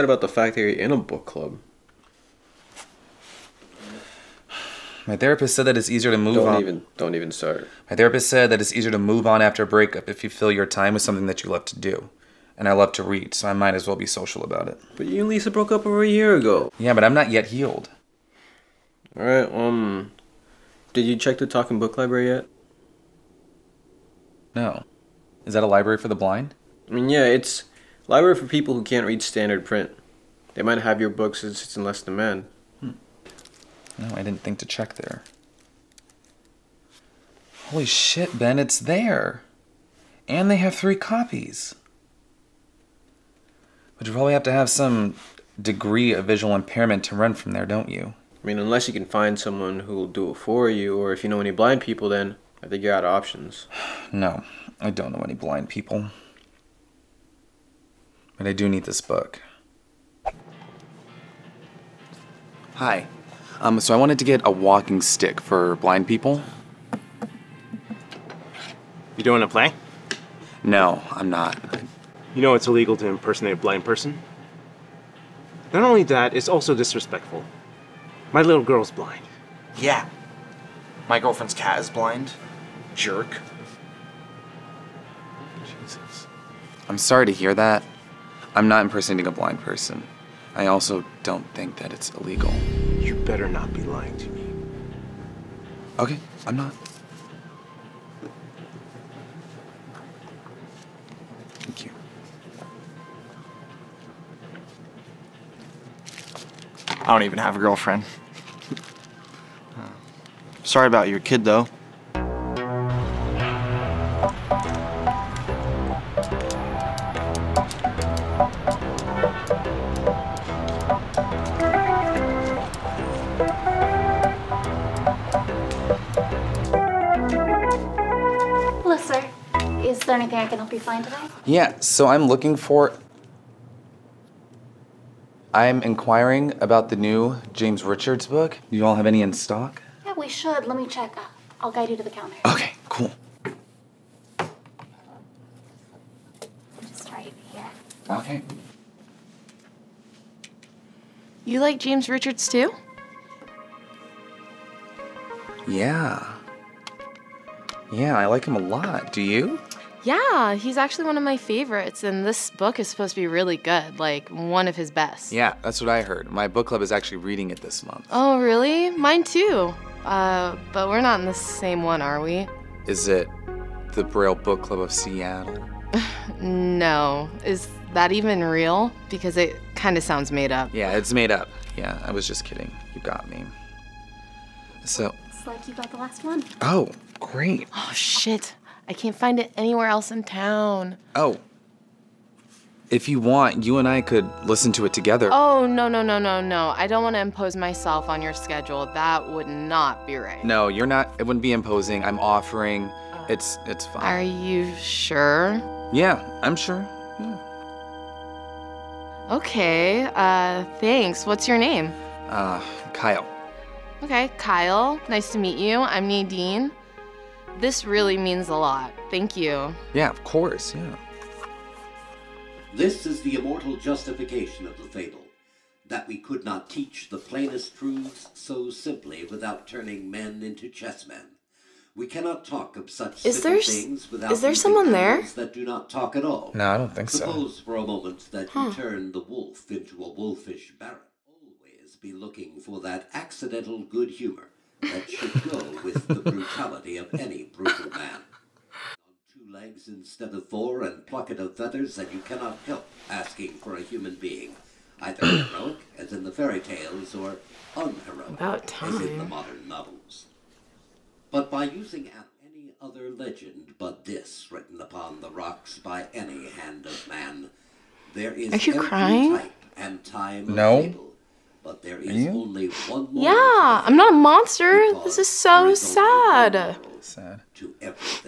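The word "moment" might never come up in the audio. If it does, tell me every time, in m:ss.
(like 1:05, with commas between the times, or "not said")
3:57.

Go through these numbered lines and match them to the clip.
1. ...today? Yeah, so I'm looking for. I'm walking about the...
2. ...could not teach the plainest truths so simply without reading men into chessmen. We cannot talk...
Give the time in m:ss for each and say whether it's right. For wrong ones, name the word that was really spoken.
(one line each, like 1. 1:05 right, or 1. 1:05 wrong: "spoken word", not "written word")
1. 2:11 wrong: "inquiring", not "walking"
2. 3:46 wrong: "turning", not "reading".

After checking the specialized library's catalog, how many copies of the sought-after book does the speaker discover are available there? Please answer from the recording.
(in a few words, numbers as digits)
3.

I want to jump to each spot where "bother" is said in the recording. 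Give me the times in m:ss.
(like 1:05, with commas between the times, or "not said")
not said.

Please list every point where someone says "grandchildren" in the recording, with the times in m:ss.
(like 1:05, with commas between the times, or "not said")
not said.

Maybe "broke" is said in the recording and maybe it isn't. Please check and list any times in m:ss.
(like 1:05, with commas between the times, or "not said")
0:15.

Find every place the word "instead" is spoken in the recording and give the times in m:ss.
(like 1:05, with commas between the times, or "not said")
4:09.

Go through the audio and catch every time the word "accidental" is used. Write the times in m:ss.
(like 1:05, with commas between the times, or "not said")
4:03.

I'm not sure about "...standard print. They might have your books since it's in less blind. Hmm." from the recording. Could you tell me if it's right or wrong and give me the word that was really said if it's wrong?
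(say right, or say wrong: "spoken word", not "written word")
wrong: "demand", not "blind".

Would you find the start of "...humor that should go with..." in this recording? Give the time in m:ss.
4:04.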